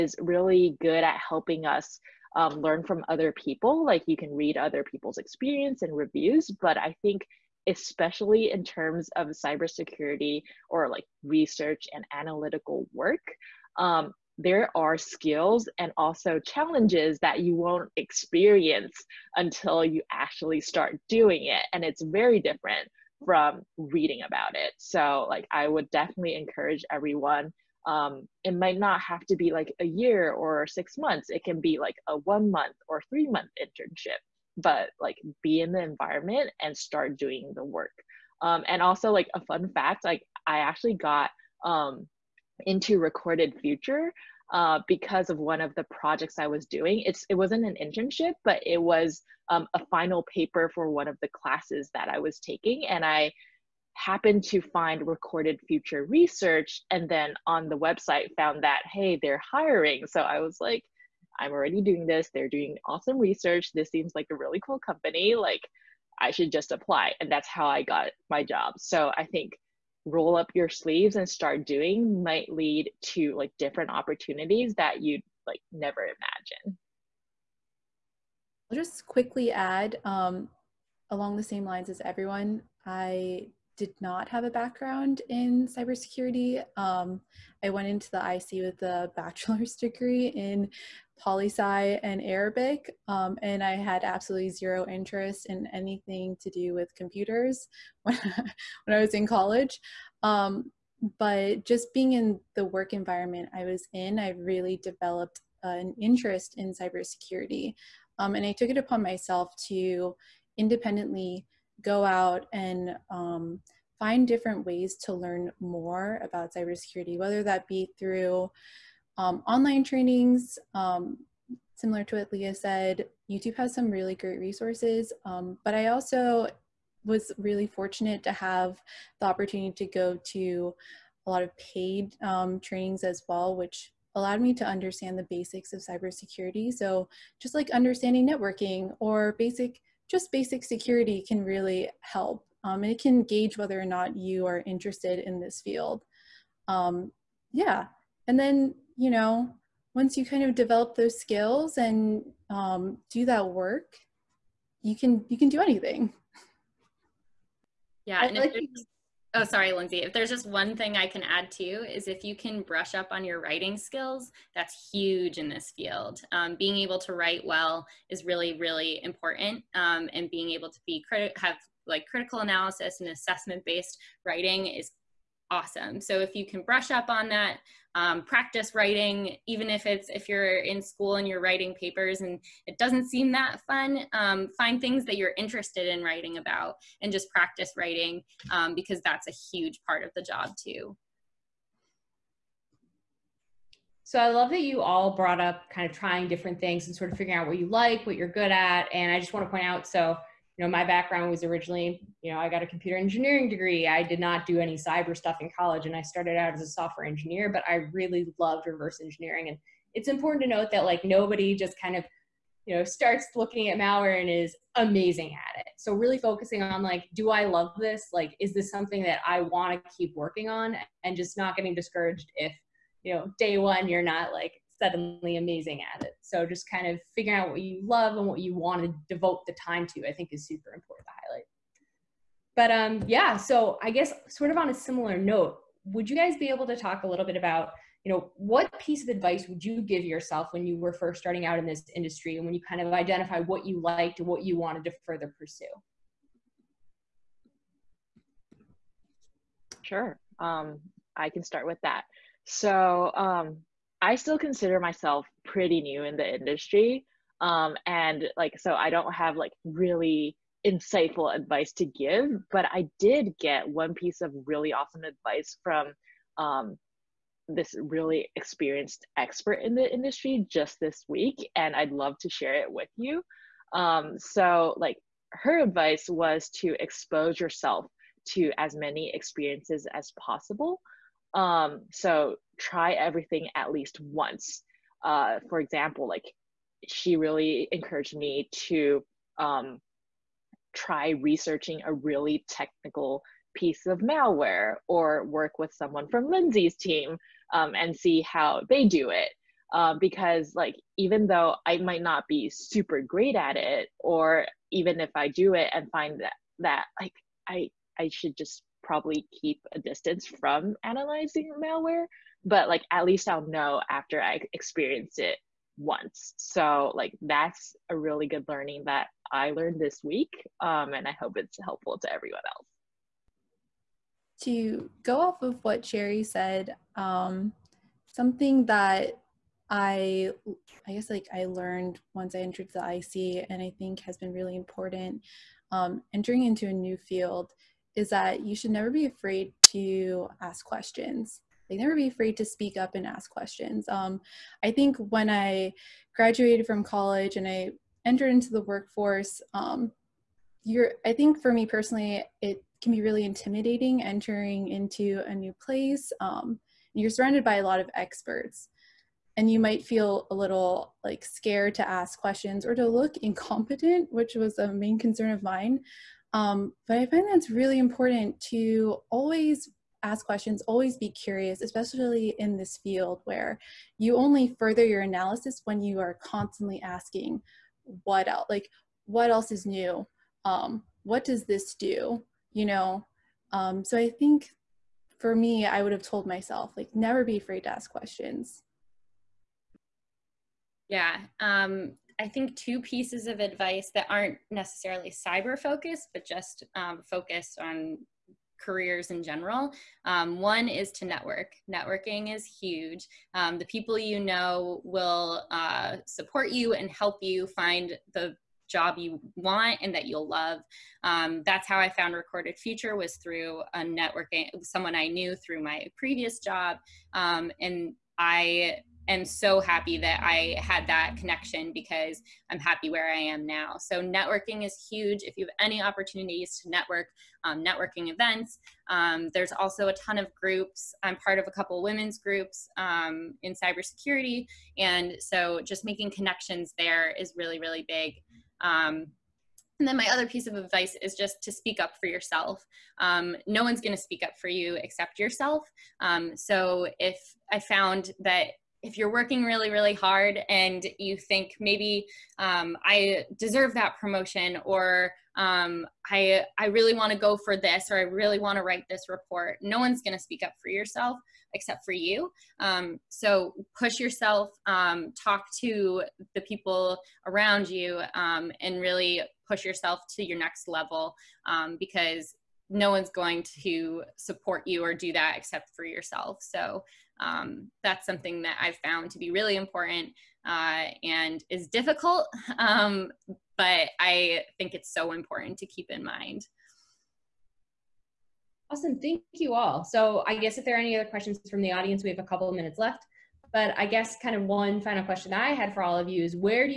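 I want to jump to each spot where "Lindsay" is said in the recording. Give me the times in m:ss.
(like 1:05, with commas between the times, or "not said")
2:39, 4:56.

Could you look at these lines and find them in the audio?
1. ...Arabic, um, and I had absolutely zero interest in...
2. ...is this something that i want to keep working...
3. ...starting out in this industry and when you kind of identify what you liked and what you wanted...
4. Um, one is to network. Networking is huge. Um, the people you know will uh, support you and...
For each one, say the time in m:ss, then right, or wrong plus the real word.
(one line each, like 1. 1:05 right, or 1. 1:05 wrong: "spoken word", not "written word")
1. 1:32 right
2. 3:38 right
3. 4:01 right
4. 6:40 right.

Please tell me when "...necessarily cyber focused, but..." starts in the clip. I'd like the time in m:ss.
6:34.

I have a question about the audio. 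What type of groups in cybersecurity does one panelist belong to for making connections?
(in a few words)
Women's groups.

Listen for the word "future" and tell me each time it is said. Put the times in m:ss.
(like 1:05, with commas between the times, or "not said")
0:43, 0:55, 6:52.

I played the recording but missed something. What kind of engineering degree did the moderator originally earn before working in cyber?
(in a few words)
Computer engineering.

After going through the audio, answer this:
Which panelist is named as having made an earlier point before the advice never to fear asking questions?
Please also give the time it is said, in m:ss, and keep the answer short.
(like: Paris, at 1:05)
Sherry, at 5:25.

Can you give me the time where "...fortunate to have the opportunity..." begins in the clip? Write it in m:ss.
2:07.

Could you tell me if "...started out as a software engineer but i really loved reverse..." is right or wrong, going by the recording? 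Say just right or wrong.
right.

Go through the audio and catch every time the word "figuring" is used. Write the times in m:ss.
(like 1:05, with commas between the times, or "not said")
3:17, 3:47.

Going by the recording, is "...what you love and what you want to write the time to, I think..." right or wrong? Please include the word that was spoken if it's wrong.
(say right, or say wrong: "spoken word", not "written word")
wrong: "devote", not "write".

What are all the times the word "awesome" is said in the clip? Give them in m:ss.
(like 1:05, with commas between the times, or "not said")
1:02, 2:55, 4:24, 8:08.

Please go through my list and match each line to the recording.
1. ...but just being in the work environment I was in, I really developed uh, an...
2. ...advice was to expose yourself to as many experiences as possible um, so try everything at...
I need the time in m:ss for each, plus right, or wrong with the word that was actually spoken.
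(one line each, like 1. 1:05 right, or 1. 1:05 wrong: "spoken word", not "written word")
1. 1:41 right
2. 4:35 right.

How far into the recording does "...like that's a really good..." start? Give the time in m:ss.
5:16.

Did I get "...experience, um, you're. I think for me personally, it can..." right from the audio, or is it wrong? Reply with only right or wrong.
wrong.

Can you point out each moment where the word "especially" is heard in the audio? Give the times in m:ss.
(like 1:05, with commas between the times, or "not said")
0:07, 6:11.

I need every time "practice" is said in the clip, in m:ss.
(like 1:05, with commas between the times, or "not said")
2:58, 3:07.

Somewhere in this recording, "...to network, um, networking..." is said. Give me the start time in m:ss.
7:06.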